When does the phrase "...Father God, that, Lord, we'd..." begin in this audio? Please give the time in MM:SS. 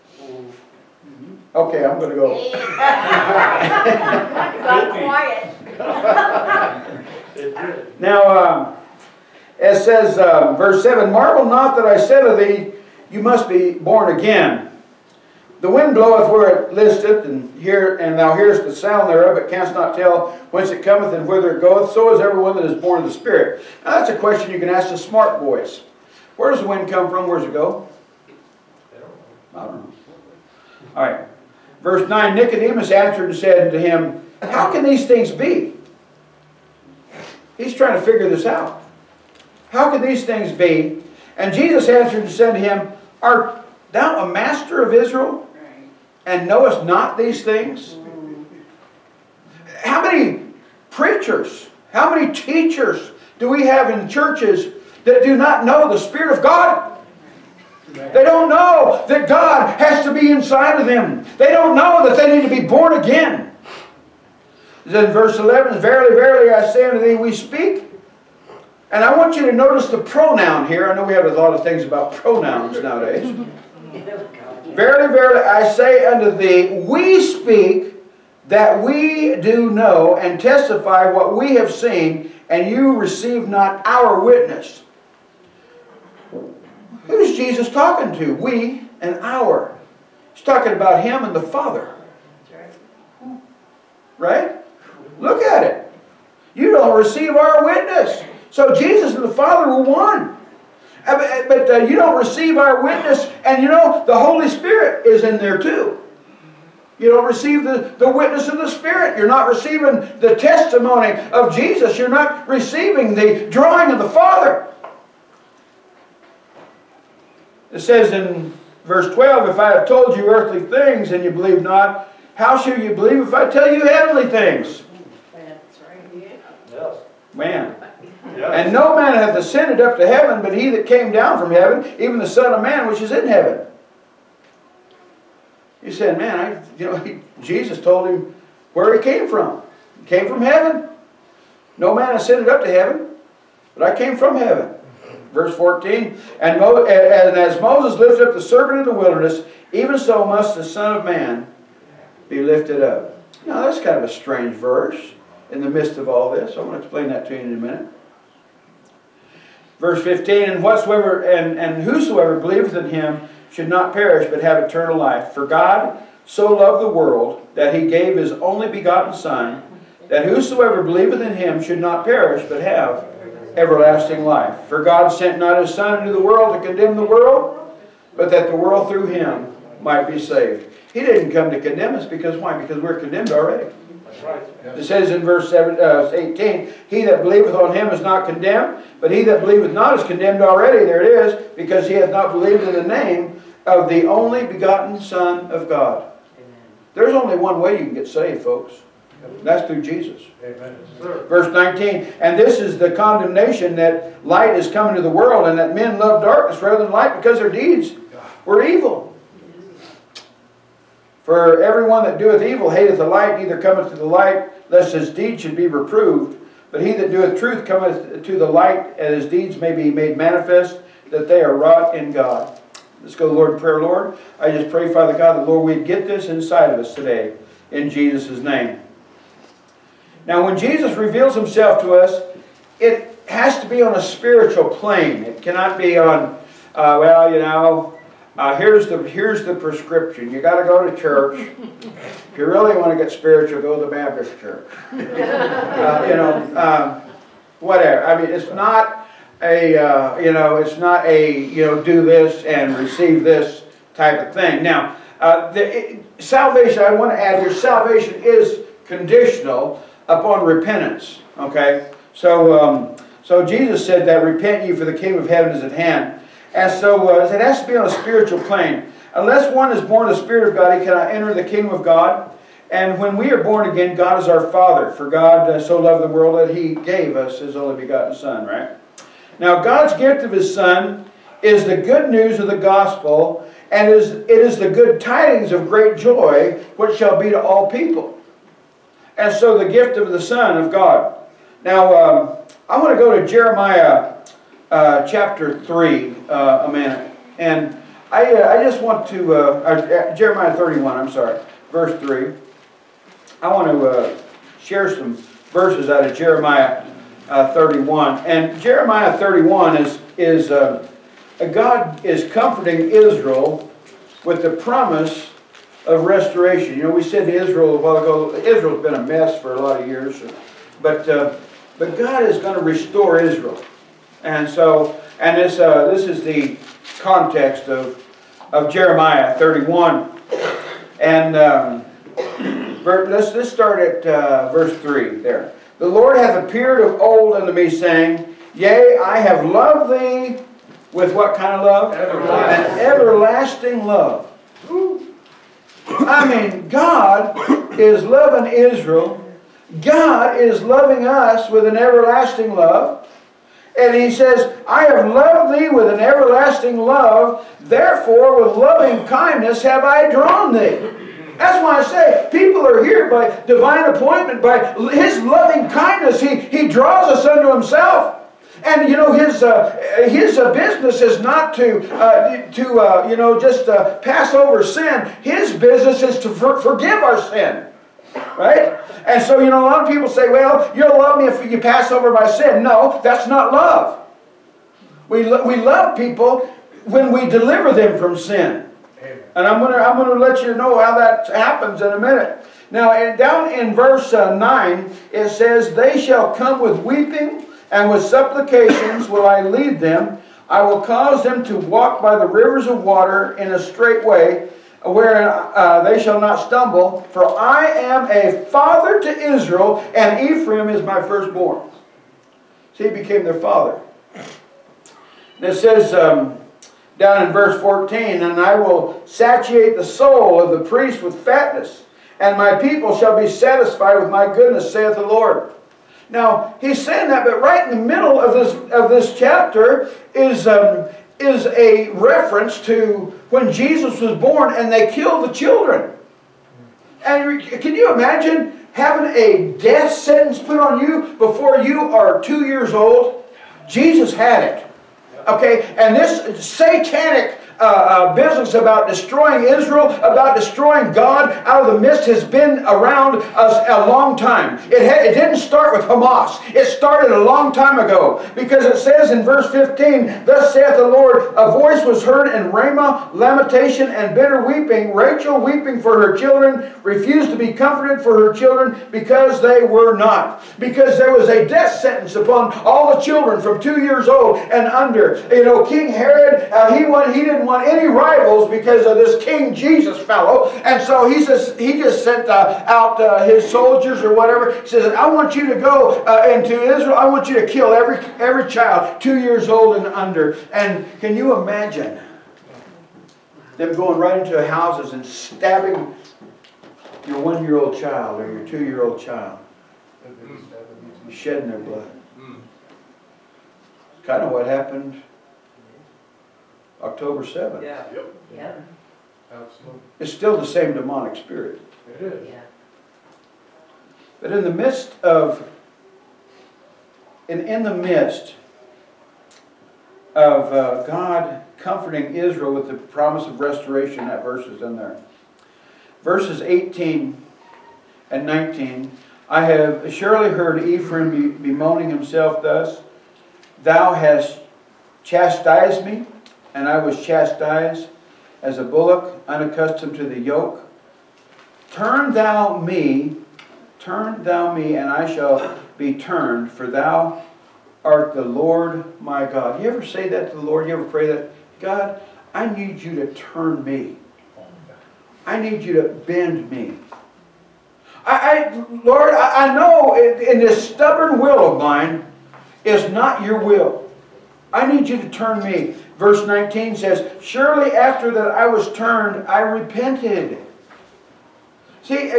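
03:44.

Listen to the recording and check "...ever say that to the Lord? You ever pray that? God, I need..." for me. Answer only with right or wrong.
right.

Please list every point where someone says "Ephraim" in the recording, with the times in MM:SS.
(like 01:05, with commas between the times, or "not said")
06:50, 08:50.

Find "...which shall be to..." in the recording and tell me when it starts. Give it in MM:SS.
04:46.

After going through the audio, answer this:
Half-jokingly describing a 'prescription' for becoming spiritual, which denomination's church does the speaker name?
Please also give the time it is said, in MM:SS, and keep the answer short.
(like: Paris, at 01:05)
Baptist, at 04:03.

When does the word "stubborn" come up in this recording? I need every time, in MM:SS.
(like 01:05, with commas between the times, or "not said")
09:20.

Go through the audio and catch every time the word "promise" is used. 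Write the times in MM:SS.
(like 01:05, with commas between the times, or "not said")
05:14, 08:42.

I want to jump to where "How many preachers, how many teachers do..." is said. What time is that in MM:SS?
00:49.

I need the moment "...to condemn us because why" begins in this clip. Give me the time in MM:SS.
03:01.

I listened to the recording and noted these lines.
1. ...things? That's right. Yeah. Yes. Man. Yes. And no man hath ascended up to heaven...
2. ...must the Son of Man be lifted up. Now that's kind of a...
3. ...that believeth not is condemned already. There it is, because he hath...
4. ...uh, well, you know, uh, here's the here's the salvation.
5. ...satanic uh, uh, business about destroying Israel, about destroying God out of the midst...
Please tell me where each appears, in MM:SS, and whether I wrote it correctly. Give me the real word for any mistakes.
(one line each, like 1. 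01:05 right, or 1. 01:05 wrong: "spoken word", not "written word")
1. 02:04 right
2. 02:30 right
3. 03:09 right
4. 03:56 wrong: "prescription", not "salvation"
5. 07:26 right.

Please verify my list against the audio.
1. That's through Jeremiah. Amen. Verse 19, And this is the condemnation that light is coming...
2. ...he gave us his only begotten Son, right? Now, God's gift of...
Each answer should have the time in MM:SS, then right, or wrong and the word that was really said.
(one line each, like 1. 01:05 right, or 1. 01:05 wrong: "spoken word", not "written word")
1. 03:19 wrong: "Jesus", not "Jeremiah"
2. 04:36 right.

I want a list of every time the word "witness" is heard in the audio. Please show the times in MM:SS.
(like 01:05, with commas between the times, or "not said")
01:24, 01:37, 01:42, 01:48.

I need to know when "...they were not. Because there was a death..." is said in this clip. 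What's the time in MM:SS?
07:49.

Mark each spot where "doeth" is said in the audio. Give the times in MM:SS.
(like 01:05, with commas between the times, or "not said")
03:32, 03:37.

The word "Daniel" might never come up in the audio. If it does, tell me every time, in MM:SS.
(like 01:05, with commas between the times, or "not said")
not said.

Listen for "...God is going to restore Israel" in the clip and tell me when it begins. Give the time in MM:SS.
05:21.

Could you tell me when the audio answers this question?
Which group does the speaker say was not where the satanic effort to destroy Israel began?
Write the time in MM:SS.
07:35.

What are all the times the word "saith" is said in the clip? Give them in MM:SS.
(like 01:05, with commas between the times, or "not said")
07:04, 07:40.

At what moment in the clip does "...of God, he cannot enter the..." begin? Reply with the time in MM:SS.
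04:30.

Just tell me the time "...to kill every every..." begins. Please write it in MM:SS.
08:07.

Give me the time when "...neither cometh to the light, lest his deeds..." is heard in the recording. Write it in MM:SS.
03:33.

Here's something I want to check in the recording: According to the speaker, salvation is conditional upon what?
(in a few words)
Repentance.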